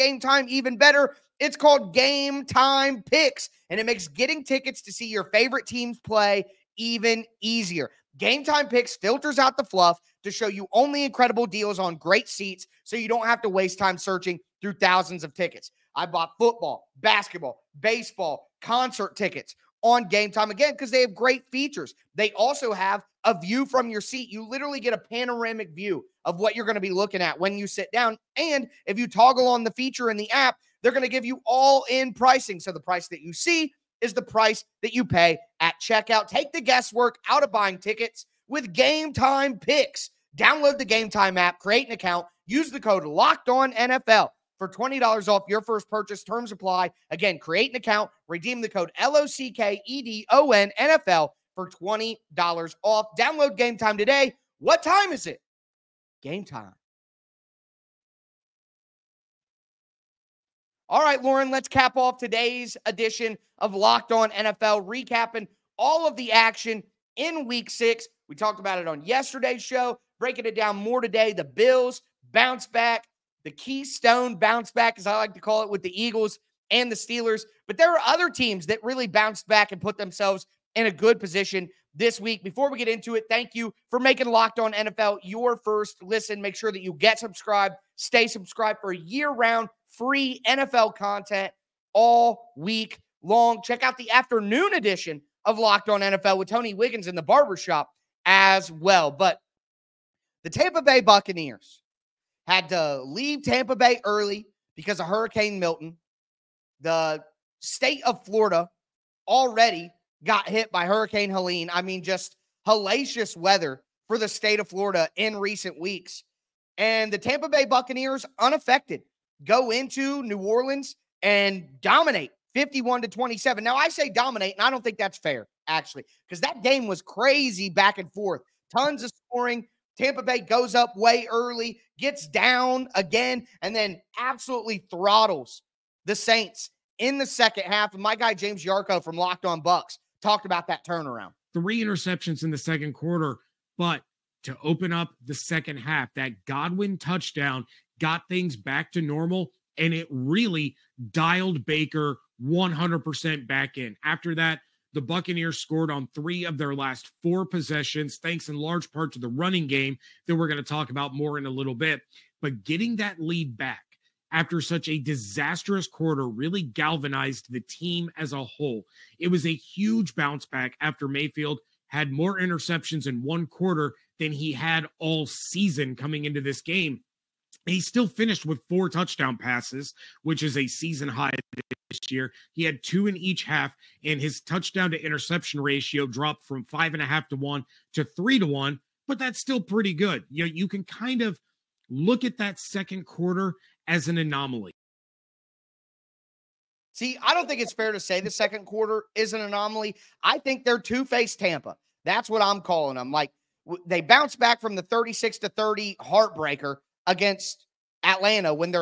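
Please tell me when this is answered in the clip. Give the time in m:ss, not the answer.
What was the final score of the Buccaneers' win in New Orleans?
2:02.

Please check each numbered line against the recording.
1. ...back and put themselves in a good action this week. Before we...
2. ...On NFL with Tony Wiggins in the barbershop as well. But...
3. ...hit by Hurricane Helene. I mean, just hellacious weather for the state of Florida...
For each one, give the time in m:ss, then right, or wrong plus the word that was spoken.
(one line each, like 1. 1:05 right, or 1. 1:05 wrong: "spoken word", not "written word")
1. 1:19 wrong: "position", not "action"
2. 1:35 right
3. 1:50 right.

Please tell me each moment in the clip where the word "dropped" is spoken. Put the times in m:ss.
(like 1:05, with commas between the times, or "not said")
3:06.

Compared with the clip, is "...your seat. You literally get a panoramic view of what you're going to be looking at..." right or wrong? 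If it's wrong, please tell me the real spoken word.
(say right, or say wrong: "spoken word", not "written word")
right.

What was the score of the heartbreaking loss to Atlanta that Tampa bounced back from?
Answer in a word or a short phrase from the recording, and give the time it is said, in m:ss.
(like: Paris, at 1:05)
36 to 30, at 3:24.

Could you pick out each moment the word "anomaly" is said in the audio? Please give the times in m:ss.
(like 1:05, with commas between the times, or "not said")
3:14, 3:19.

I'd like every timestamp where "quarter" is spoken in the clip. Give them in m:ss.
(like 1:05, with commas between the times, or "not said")
2:22, 2:45, 2:53, 3:13, 3:18.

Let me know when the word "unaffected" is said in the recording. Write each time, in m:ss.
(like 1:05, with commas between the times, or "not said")
1:58.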